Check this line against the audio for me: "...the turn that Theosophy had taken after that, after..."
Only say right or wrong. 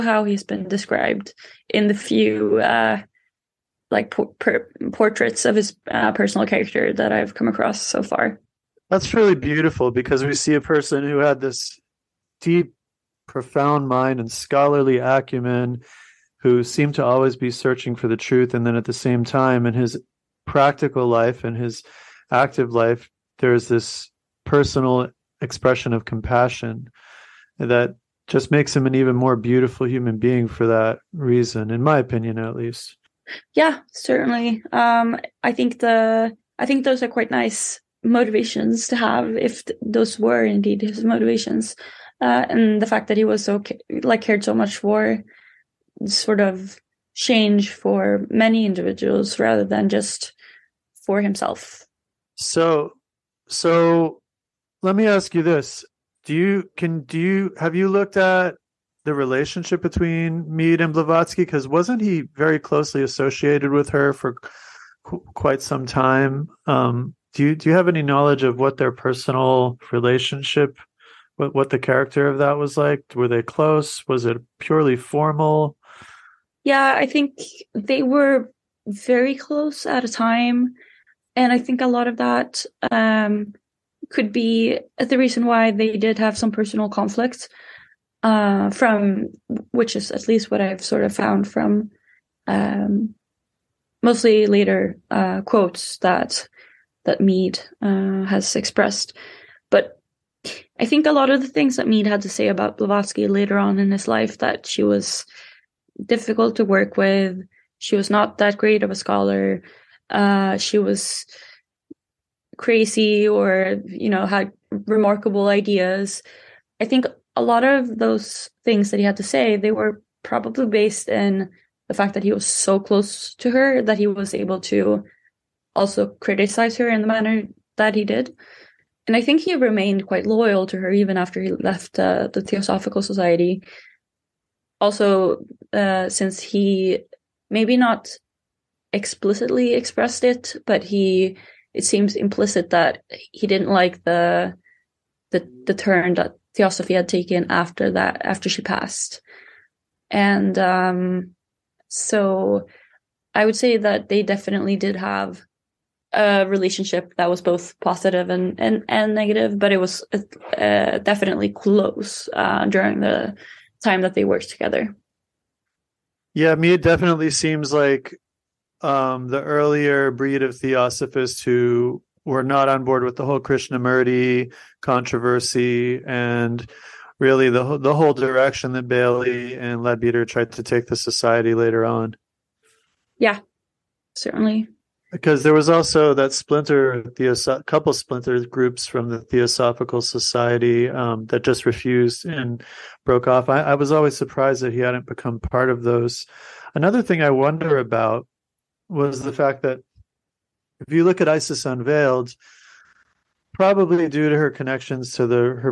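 right.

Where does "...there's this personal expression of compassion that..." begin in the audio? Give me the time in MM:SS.
00:23.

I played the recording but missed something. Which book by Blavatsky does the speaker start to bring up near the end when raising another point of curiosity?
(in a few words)
Isis Unveiled.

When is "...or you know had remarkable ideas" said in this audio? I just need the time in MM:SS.
01:53.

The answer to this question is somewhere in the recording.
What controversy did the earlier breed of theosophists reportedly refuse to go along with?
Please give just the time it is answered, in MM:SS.
02:53.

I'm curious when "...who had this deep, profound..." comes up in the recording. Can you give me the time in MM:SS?
00:11.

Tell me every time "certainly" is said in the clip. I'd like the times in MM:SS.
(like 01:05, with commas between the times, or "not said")
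00:33, 03:04.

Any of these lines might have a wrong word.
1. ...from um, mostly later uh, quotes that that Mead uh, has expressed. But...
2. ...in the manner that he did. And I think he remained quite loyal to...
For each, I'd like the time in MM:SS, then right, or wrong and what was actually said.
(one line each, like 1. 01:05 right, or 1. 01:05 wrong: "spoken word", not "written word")
1. 01:31 right
2. 02:06 right.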